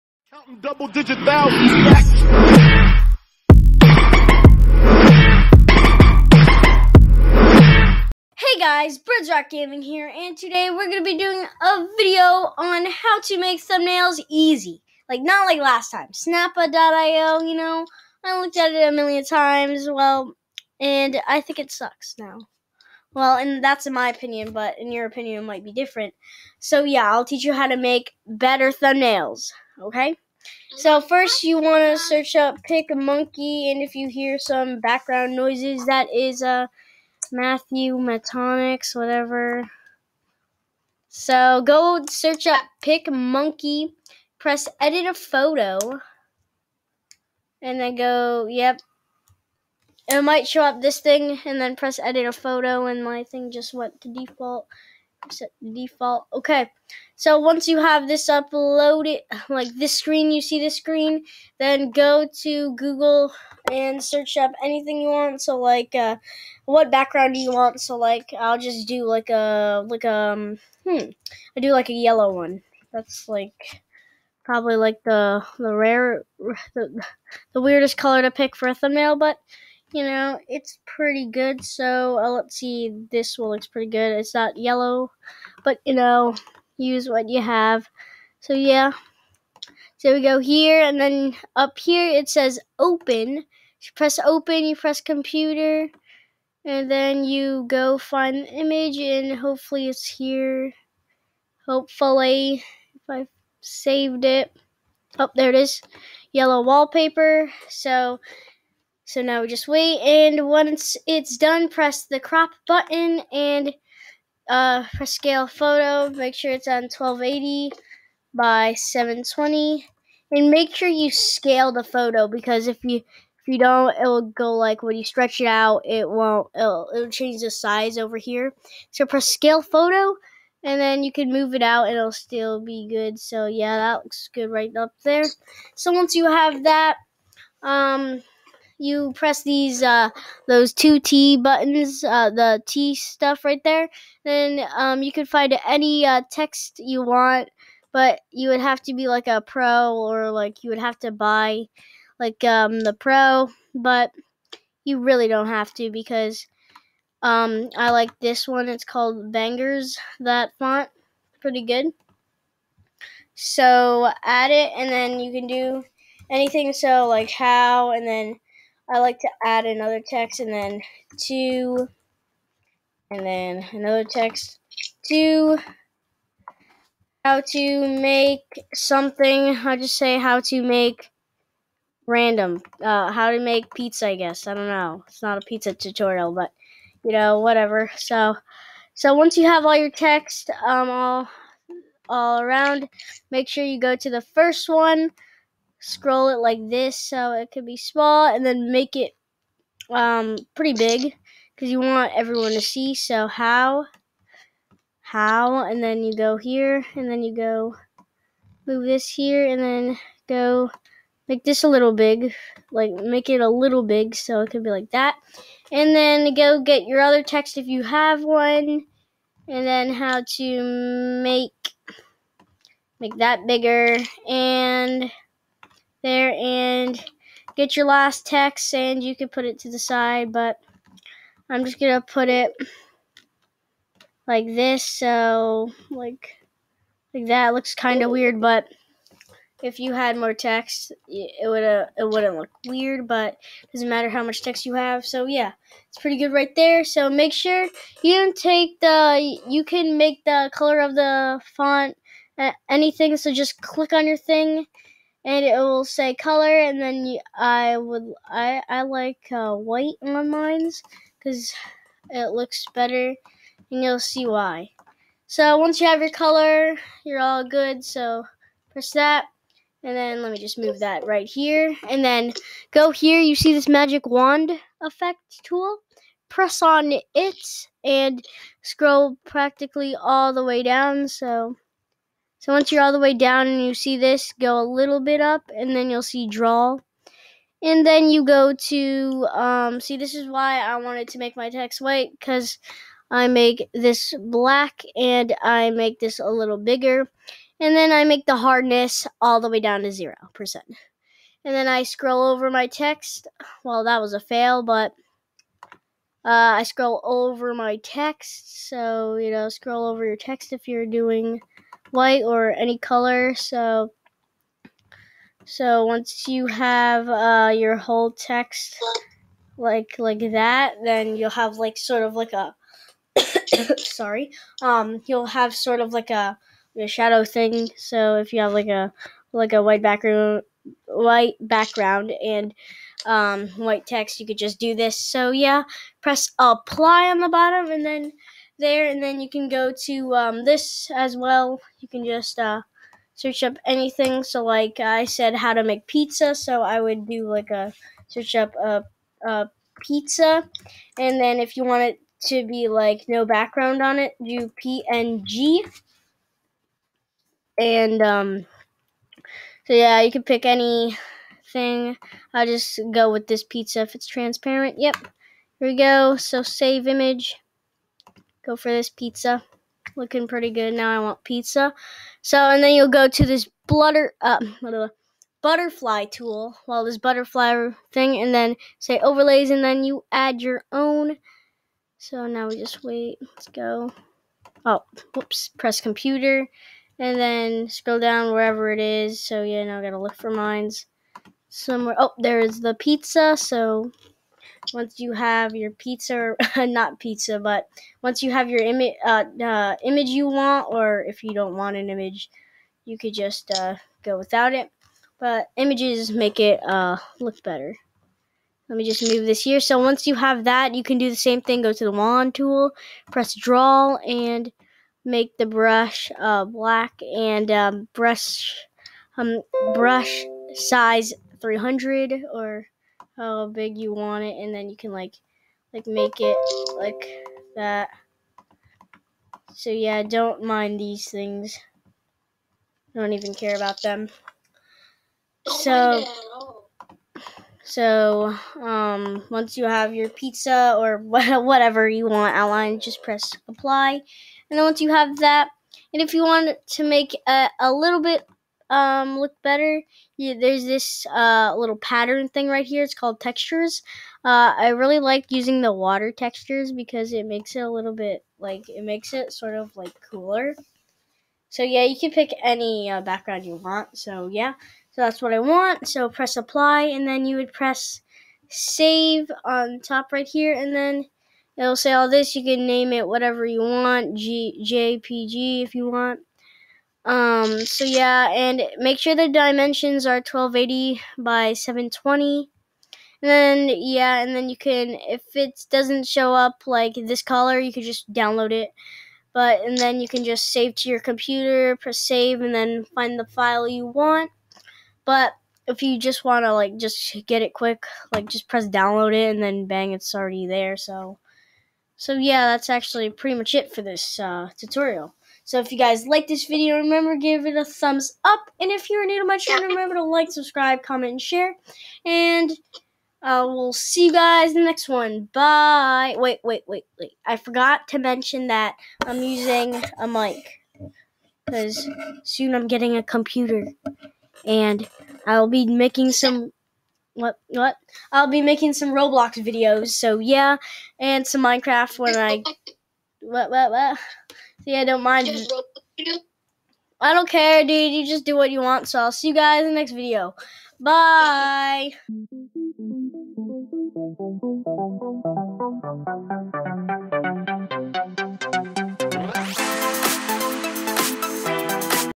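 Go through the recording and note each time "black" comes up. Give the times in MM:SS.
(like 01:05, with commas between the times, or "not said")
04:54, 06:56.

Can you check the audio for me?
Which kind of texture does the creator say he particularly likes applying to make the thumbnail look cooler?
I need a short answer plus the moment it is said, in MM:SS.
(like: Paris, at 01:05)
water textures, at 07:35.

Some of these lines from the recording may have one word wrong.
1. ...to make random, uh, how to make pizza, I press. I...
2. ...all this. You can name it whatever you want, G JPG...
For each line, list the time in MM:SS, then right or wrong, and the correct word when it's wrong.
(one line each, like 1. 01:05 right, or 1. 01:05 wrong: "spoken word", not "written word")
1. 03:00 wrong: "guess", not "press"
2. 07:51 right.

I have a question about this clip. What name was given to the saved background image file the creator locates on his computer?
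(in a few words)
Yellow wallpaper.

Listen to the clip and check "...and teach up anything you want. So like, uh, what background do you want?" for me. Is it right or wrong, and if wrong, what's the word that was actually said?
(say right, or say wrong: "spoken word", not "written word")
wrong: "search", not "teach".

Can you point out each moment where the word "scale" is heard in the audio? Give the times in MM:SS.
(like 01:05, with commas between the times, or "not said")
01:55, 02:01, 02:09.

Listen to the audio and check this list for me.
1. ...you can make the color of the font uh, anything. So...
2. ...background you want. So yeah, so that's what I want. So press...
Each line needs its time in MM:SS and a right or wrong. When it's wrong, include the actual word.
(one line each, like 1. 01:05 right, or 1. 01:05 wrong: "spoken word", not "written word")
1. 04:09 right
2. 07:43 right.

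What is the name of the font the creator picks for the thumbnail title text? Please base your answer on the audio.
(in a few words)
Bangers.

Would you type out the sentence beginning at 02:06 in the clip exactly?
It'll, it'll change the size over here.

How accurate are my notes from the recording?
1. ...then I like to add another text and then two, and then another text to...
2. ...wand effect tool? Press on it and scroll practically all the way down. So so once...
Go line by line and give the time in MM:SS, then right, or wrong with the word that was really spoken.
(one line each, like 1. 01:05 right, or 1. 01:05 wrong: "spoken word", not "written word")
1. 02:48 right
2. 04:34 right.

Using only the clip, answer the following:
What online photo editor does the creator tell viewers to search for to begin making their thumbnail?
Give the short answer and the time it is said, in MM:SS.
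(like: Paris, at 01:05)
PicMonkey, at 00:42.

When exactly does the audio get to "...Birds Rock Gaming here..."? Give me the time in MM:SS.
00:08.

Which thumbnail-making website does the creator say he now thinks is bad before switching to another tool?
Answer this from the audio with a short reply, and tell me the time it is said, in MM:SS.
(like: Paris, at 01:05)
Snappa.io, at 00:16.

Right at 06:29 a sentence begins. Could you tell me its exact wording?
So yeah, now I gotta look for mines somewhere.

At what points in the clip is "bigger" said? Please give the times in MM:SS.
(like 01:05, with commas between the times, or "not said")
03:43, 04:56.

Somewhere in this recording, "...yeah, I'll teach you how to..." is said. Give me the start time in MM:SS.
00:26.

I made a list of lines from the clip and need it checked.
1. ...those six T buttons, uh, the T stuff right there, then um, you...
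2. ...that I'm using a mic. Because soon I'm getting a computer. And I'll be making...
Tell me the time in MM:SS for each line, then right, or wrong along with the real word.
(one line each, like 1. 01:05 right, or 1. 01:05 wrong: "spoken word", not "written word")
1. 02:20 wrong: "two", not "six"
2. 08:38 right.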